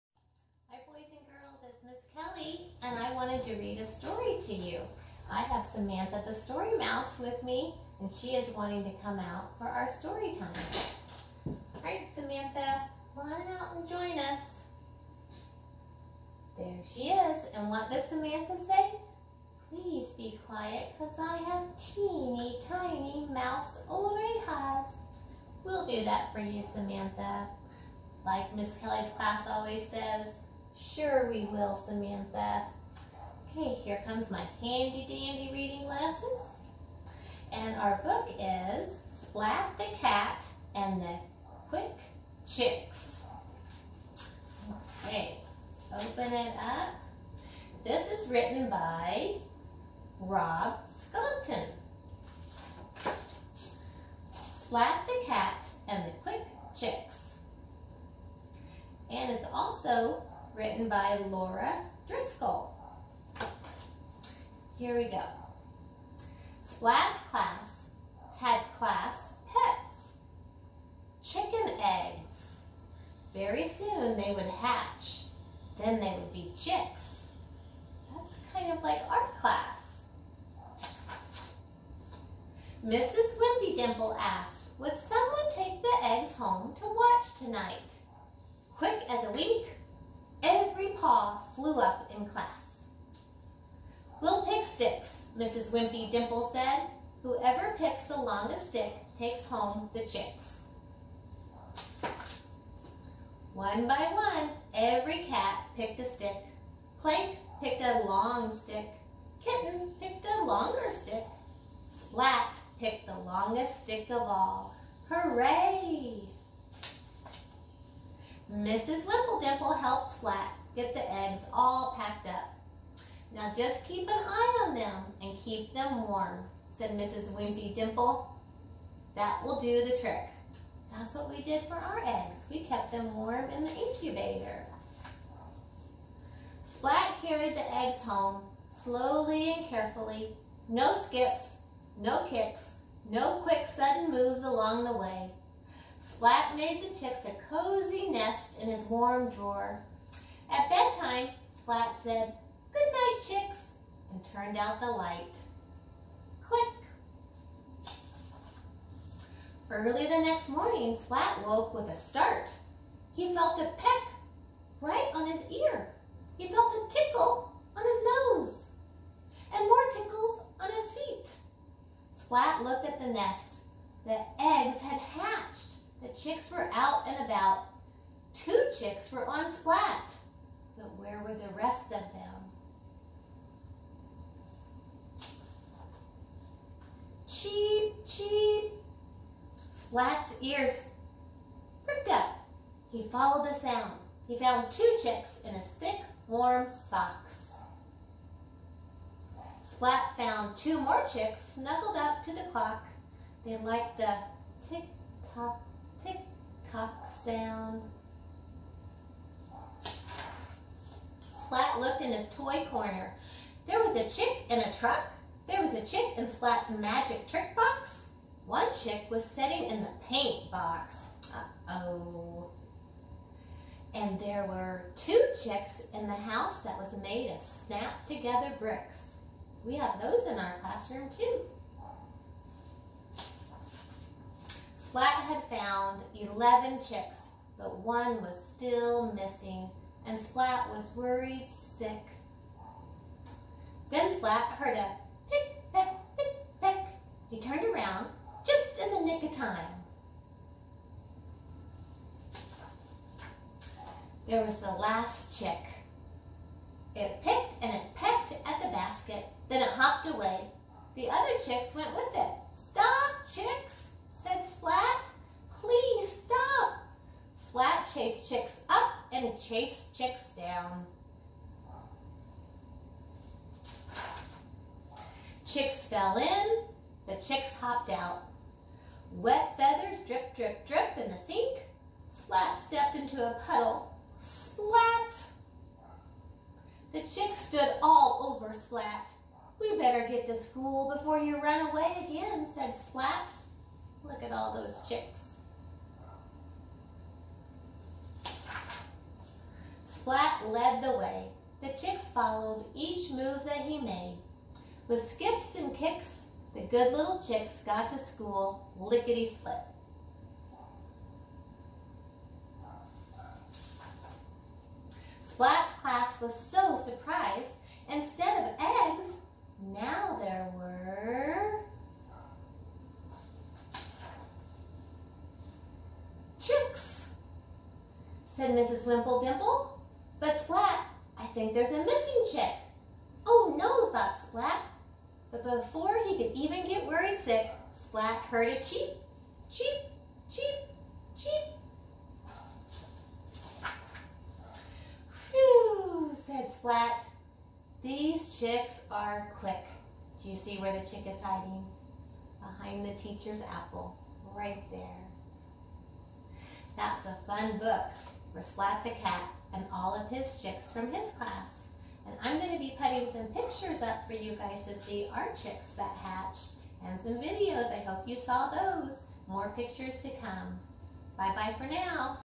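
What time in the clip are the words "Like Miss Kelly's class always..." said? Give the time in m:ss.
0:28.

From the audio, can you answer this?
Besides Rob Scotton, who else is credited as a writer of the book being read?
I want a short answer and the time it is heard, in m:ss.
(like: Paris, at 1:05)
Laura Driscoll, at 1:01.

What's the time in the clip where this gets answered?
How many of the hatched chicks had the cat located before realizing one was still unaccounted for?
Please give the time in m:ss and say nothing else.
3:56.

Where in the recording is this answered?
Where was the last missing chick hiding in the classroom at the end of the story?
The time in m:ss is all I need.
5:52.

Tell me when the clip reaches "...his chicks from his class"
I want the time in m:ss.
6:00.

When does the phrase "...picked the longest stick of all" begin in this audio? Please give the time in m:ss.
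1:52.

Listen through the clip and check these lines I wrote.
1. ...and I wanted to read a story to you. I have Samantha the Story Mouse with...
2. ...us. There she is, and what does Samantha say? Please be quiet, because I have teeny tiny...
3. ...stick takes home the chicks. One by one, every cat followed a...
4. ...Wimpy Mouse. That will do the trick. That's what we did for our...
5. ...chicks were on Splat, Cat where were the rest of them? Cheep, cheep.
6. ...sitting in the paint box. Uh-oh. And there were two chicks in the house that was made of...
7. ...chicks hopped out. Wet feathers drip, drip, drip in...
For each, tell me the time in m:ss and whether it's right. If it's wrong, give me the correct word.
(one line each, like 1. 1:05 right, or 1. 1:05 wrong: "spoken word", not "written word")
1. 0:02 right
2. 0:14 right
3. 1:38 wrong: "picked", not "followed"
4. 2:07 wrong: "Dimple", not "Mouse"
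5. 2:58 wrong: "But", not "Cat"
6. 3:39 right
7. 4:37 right.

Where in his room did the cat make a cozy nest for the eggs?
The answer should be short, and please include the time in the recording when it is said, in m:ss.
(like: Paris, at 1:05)
His warm drawer, at 2:28.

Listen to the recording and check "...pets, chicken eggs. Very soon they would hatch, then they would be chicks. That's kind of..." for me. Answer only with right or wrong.
right.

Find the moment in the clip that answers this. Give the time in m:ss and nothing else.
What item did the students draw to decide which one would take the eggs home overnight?
1:34.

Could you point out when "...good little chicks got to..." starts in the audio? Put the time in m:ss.
5:06.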